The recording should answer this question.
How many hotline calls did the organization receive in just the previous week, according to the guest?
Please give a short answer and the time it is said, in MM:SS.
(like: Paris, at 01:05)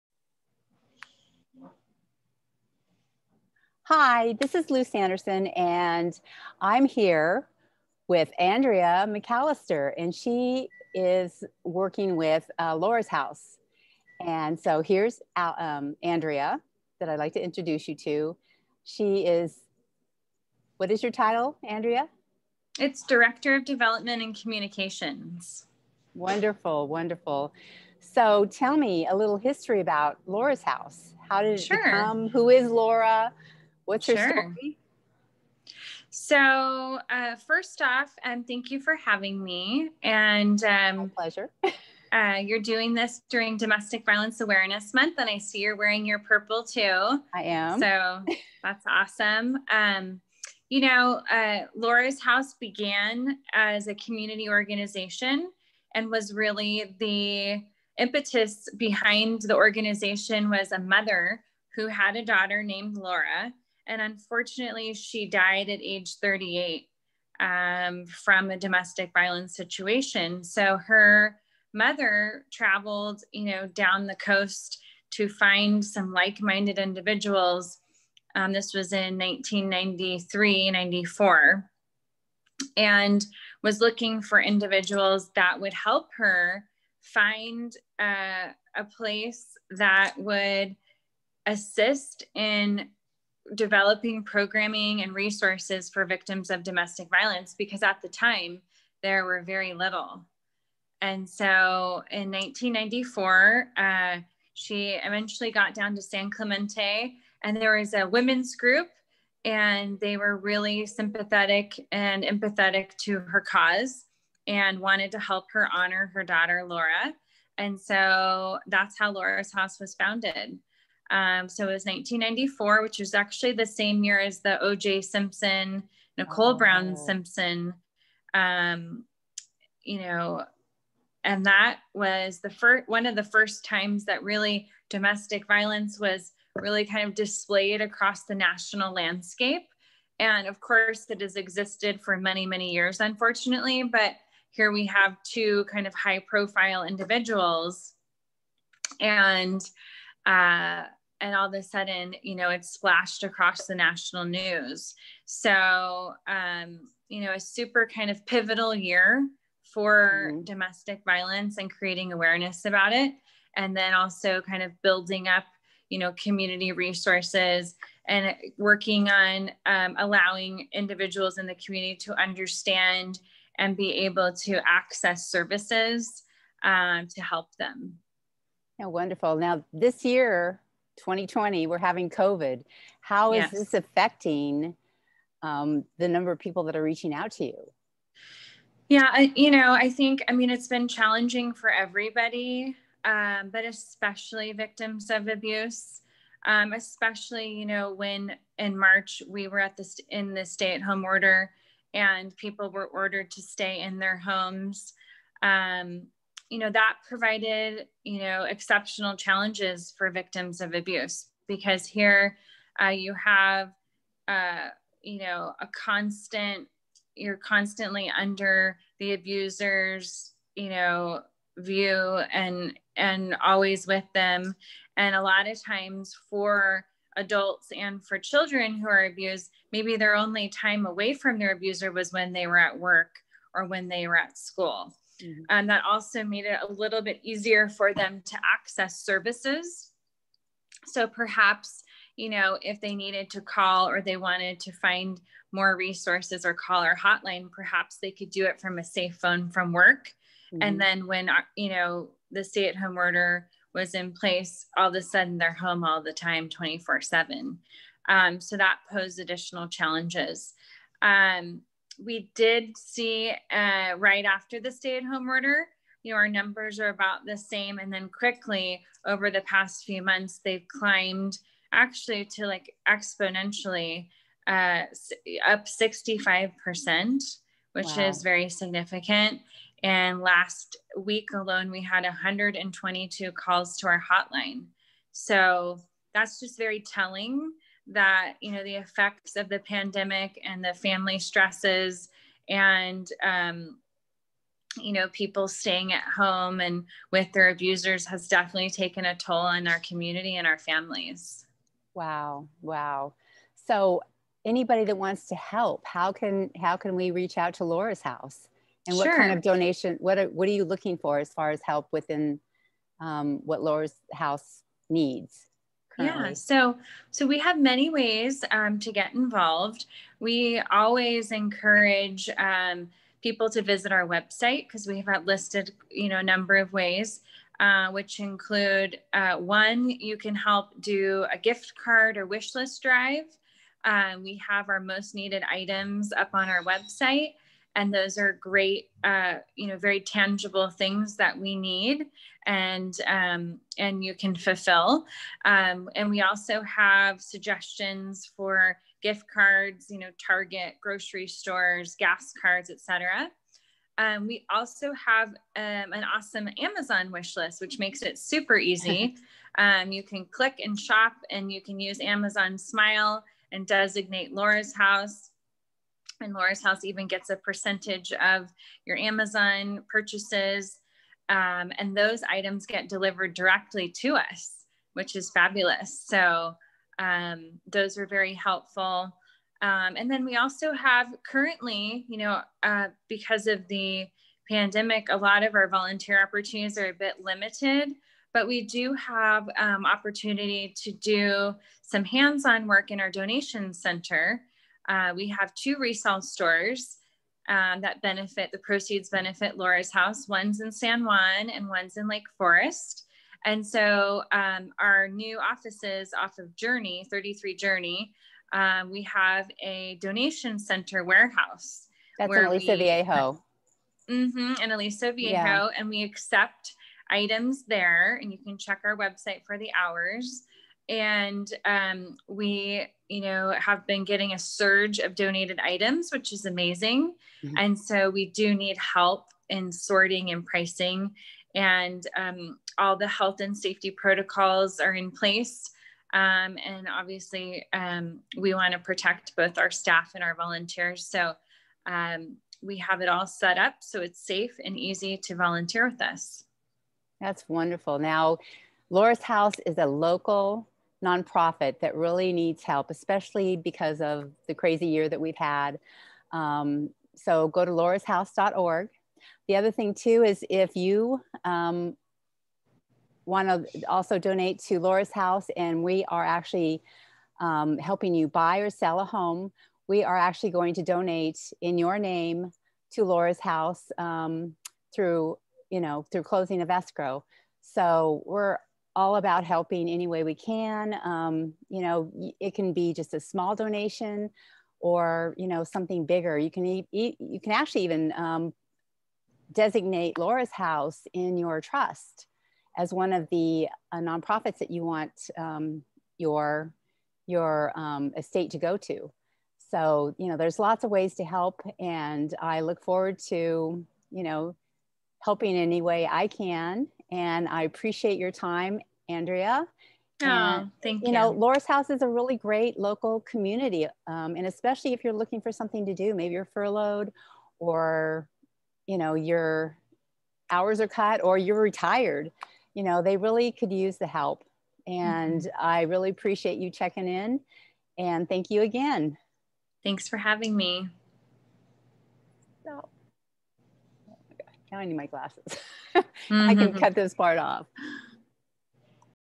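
122, at 04:42.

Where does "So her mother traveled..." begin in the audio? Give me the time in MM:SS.
01:10.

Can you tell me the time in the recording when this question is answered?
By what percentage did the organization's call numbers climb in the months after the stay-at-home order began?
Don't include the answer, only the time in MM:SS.
04:35.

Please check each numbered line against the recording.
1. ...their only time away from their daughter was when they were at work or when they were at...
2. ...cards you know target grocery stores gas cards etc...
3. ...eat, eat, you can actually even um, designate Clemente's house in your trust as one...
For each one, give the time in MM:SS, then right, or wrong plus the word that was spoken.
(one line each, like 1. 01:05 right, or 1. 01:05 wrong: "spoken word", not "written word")
1. 03:49 wrong: "abuser", not "daughter"
2. 05:49 right
3. 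08:06 wrong: "Laura", not "Clemente".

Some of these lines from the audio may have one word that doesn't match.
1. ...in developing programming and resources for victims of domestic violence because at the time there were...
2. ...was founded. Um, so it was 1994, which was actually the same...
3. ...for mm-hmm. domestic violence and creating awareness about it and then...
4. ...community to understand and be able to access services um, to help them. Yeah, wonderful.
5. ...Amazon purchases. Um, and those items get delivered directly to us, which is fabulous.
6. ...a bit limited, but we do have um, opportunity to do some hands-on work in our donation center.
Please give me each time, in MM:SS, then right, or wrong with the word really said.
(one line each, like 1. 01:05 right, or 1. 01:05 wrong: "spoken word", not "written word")
1. 01:32 right
2. 01:59 right
3. 02:39 right
4. 02:51 right
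5. 06:08 right
6. 06:26 right.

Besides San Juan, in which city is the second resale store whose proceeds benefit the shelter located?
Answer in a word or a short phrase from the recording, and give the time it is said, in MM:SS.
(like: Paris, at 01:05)
Lake Forest, at 06:42.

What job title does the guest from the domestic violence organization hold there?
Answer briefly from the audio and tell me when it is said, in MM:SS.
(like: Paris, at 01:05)
Director of Development and Communications, at 00:23.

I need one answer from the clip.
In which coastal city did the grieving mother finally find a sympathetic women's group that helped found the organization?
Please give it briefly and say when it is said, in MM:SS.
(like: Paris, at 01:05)
San Clemente, at 01:46.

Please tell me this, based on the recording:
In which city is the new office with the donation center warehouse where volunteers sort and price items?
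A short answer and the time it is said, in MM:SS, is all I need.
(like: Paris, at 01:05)
Aliso Viejo, at 06:54.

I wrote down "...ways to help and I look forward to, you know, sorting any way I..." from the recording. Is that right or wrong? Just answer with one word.
wrong.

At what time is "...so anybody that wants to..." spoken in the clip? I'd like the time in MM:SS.
05:03.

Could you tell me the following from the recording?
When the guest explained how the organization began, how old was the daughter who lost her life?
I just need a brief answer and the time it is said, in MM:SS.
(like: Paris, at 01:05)
38, at 01:06.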